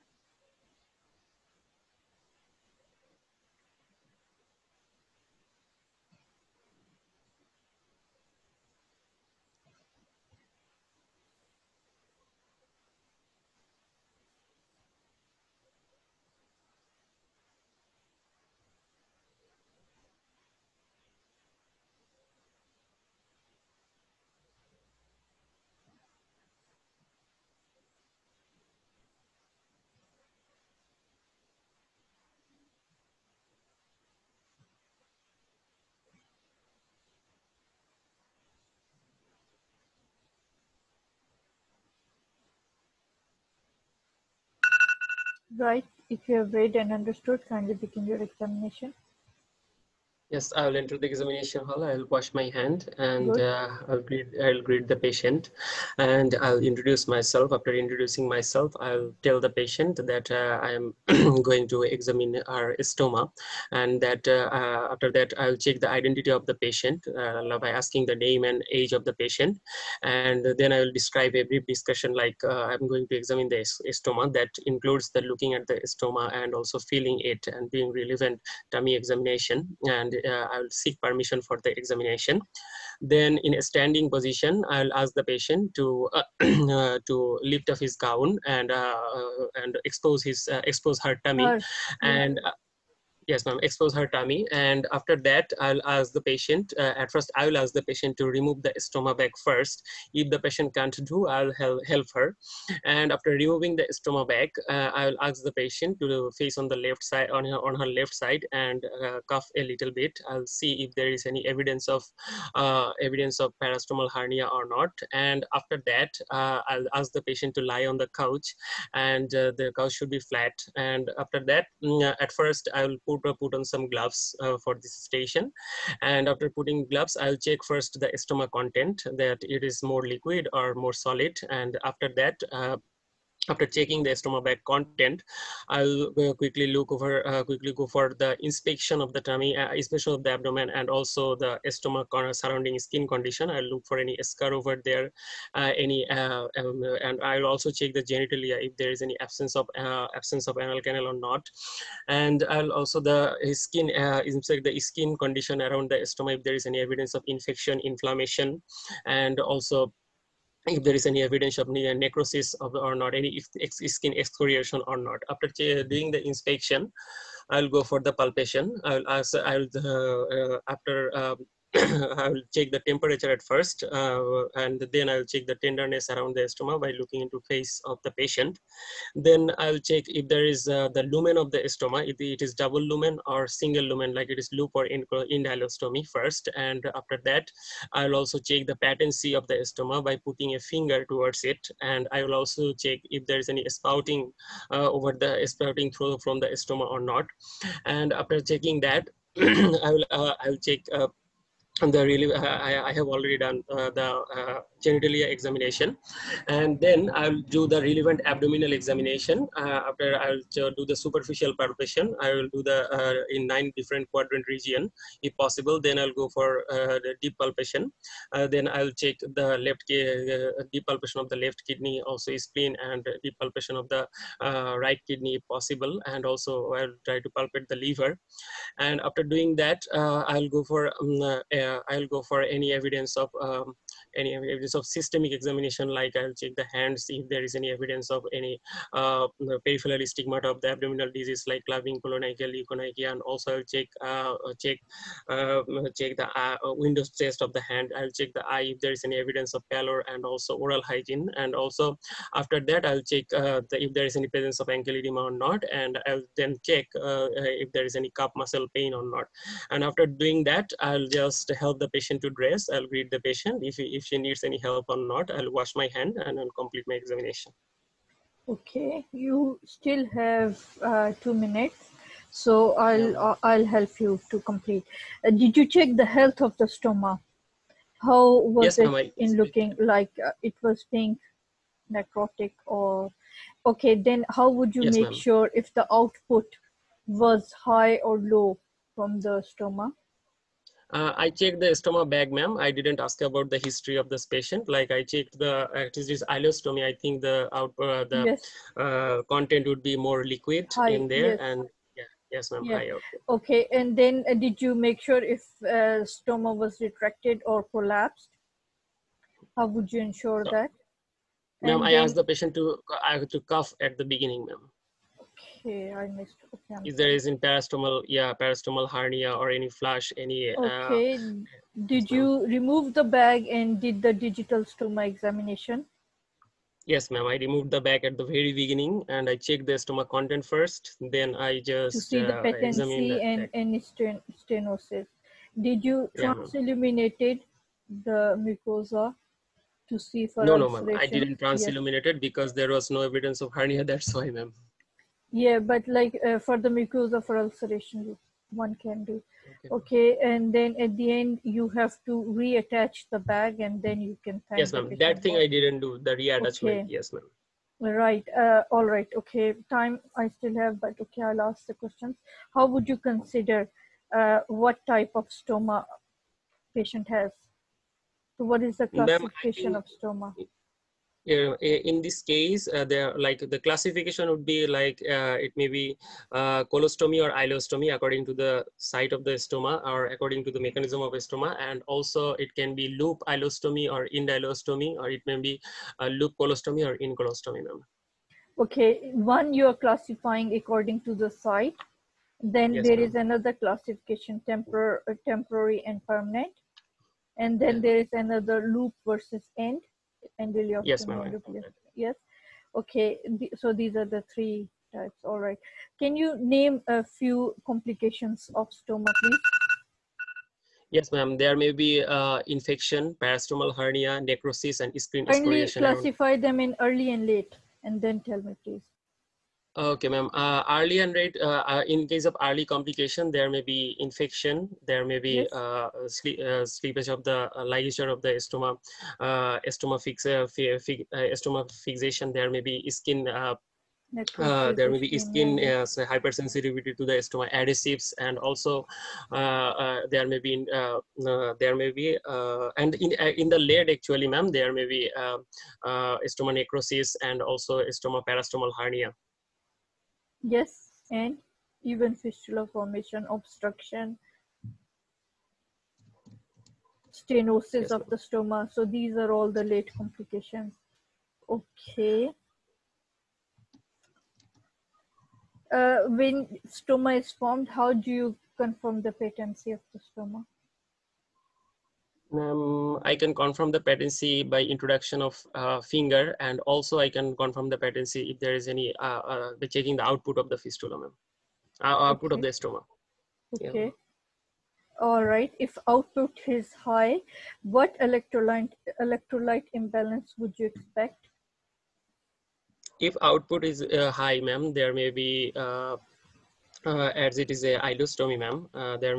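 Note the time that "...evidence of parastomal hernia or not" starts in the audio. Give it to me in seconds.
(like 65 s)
112 s.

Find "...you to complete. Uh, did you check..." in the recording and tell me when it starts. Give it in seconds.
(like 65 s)
273 s.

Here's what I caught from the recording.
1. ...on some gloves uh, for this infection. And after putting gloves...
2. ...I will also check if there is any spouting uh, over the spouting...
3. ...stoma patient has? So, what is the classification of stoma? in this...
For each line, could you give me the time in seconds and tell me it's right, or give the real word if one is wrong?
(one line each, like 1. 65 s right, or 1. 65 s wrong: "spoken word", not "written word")
1. 123 s wrong: "station", not "infection"
2. 192 s right
3. 365 s right.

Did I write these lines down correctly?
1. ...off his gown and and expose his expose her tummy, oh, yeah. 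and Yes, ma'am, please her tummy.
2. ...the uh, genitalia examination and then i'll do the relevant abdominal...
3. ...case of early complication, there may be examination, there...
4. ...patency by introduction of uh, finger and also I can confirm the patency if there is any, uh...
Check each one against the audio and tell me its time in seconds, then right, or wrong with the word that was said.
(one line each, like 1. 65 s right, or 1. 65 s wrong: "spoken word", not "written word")
1. 87 s wrong: "expose", not "please"
2. 203 s right
3. 422 s wrong: "infection", not "examination"
4. 473 s right.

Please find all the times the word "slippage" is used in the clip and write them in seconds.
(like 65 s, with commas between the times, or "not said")
426 s.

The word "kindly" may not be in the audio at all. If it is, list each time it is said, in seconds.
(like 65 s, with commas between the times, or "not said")
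47 s, 415 s.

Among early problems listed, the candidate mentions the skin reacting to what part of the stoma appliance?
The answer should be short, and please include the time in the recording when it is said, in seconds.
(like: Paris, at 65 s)
stoma adhesives, at 437 s.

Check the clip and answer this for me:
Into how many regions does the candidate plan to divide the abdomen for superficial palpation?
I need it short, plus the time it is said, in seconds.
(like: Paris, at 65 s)
9, at 213 s.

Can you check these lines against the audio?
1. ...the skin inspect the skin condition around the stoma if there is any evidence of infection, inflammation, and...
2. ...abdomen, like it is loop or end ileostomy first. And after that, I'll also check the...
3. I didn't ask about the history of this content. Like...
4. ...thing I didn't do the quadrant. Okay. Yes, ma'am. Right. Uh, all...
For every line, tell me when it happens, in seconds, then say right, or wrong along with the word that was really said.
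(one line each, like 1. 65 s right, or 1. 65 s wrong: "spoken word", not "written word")
1. 152 s right
2. 183 s wrong: "lumen", not "abdomen"
3. 292 s wrong: "patient", not "content"
4. 355 s wrong: "reattachment", not "quadrant".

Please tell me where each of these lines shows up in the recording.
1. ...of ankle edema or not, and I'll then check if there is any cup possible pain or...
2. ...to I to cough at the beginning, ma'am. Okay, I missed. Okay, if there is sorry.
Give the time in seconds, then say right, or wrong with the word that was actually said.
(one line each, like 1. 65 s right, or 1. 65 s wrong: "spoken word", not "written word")
1. 254 s wrong: "muscle", not "possible"
2. 312 s right.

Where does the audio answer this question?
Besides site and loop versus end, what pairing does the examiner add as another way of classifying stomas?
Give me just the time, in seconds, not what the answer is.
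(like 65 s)
395 s.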